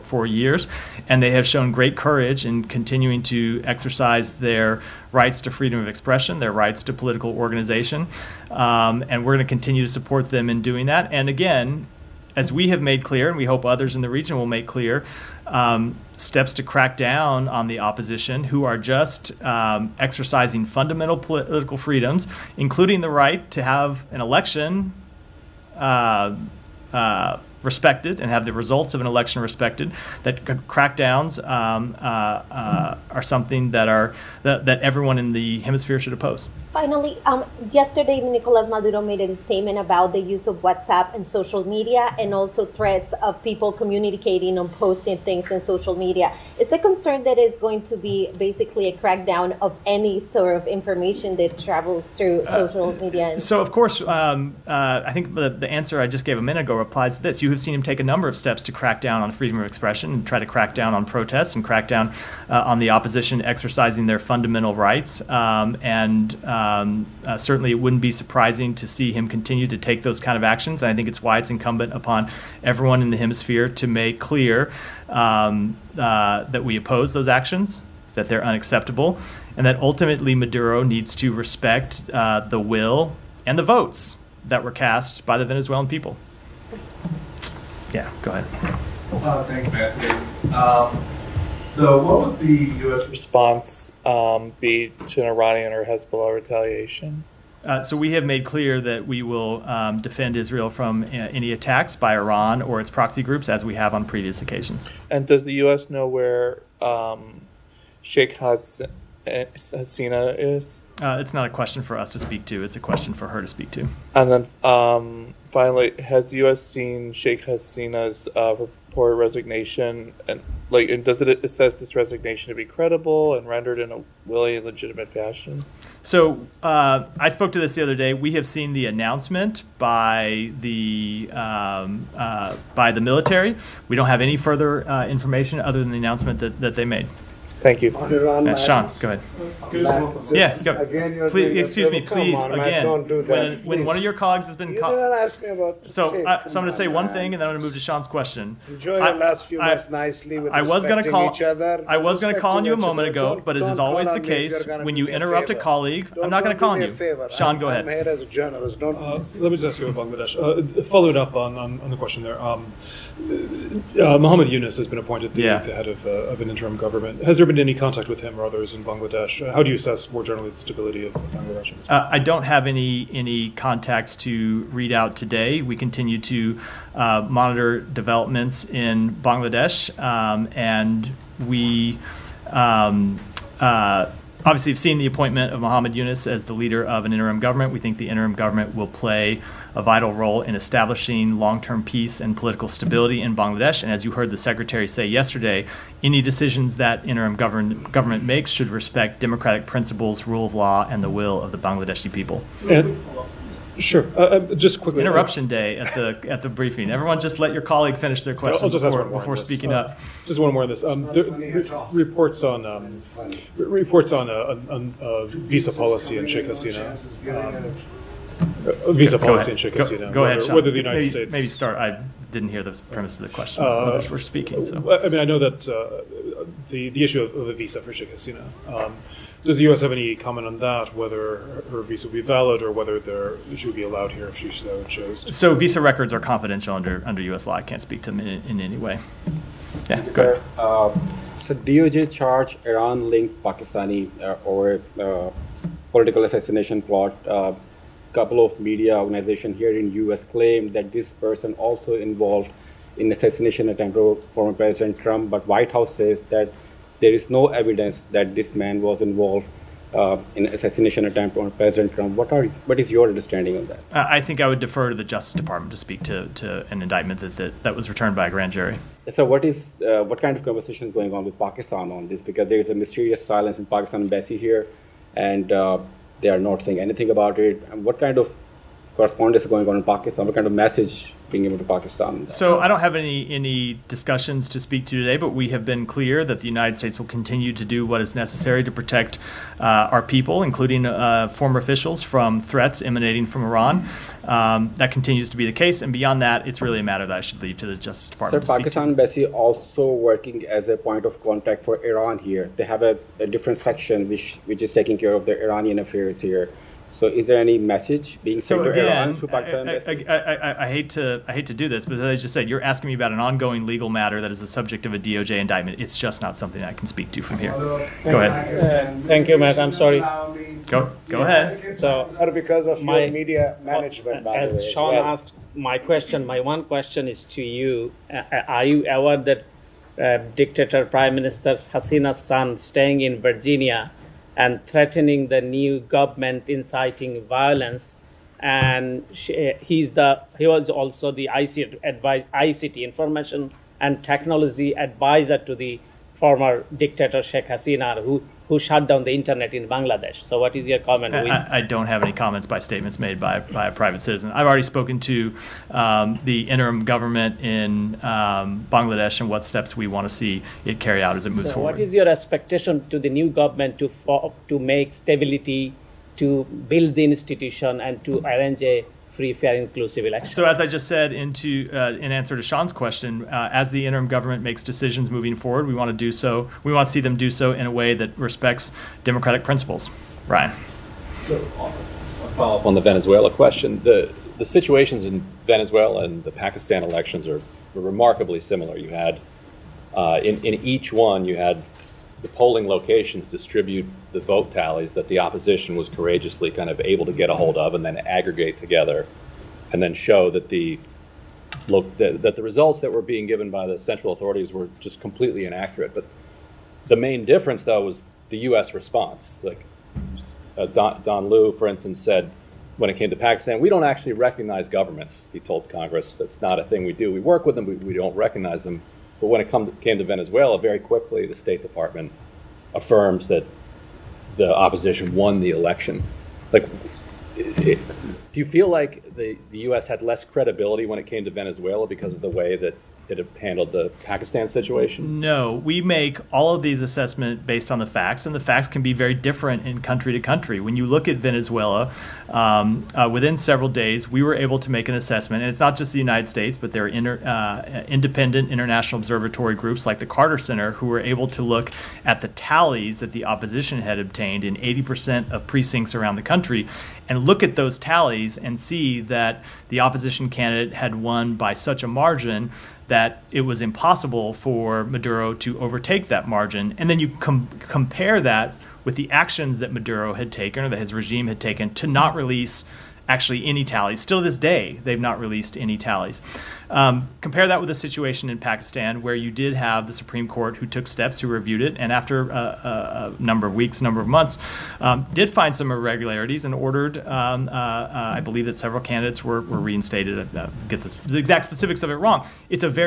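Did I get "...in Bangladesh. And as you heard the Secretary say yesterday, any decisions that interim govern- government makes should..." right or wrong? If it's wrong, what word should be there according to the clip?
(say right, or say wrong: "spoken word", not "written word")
right.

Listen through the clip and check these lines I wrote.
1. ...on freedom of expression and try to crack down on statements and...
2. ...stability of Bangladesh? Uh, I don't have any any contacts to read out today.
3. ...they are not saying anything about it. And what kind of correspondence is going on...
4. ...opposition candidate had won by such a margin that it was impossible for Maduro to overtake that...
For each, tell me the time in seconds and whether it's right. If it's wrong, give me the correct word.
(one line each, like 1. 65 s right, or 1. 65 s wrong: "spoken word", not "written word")
1. 59 s wrong: "protests", not "statements"
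2. 170 s right
3. 276 s right
4. 459 s right.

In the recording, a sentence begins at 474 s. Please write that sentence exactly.
Still to this day, they've not released any tallies.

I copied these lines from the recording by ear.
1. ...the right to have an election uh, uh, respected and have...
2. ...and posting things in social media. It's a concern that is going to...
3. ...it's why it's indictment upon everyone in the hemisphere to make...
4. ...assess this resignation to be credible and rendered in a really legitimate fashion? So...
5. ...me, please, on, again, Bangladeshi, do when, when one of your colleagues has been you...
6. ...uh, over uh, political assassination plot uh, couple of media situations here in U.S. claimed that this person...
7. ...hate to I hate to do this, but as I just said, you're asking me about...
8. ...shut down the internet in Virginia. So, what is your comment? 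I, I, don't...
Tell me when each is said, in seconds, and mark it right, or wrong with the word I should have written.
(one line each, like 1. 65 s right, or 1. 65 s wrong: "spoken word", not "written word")
1. 23 s right
2. 44 s right
3. 71 s wrong: "incumbent", not "indictment"
4. 121 s right
5. 141 s wrong: "Matt", not "Bangladeshi"
6. 244 s wrong: "organizations", not "situations"
7. 310 s right
8. 348 s wrong: "Bangladesh", not "Virginia".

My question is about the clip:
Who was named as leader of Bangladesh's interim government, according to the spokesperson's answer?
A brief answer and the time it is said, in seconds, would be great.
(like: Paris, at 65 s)
Mohammed Yunus, at 185 s.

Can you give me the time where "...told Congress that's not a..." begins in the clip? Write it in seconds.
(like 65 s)
415 s.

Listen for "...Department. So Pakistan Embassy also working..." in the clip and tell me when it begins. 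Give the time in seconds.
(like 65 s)
298 s.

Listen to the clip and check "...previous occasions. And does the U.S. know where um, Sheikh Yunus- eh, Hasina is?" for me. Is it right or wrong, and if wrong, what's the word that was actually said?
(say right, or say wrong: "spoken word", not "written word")
wrong: "Has", not "Yunus".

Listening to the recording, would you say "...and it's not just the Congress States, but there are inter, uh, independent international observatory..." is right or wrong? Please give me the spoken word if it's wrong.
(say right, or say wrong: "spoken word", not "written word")
wrong: "United", not "Congress".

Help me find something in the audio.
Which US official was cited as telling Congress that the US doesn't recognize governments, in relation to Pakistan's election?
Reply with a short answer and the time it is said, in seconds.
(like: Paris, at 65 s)
Don Lu, at 411 s.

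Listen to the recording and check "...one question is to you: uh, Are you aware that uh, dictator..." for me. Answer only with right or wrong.
right.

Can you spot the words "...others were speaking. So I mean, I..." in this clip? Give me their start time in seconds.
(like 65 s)
223 s.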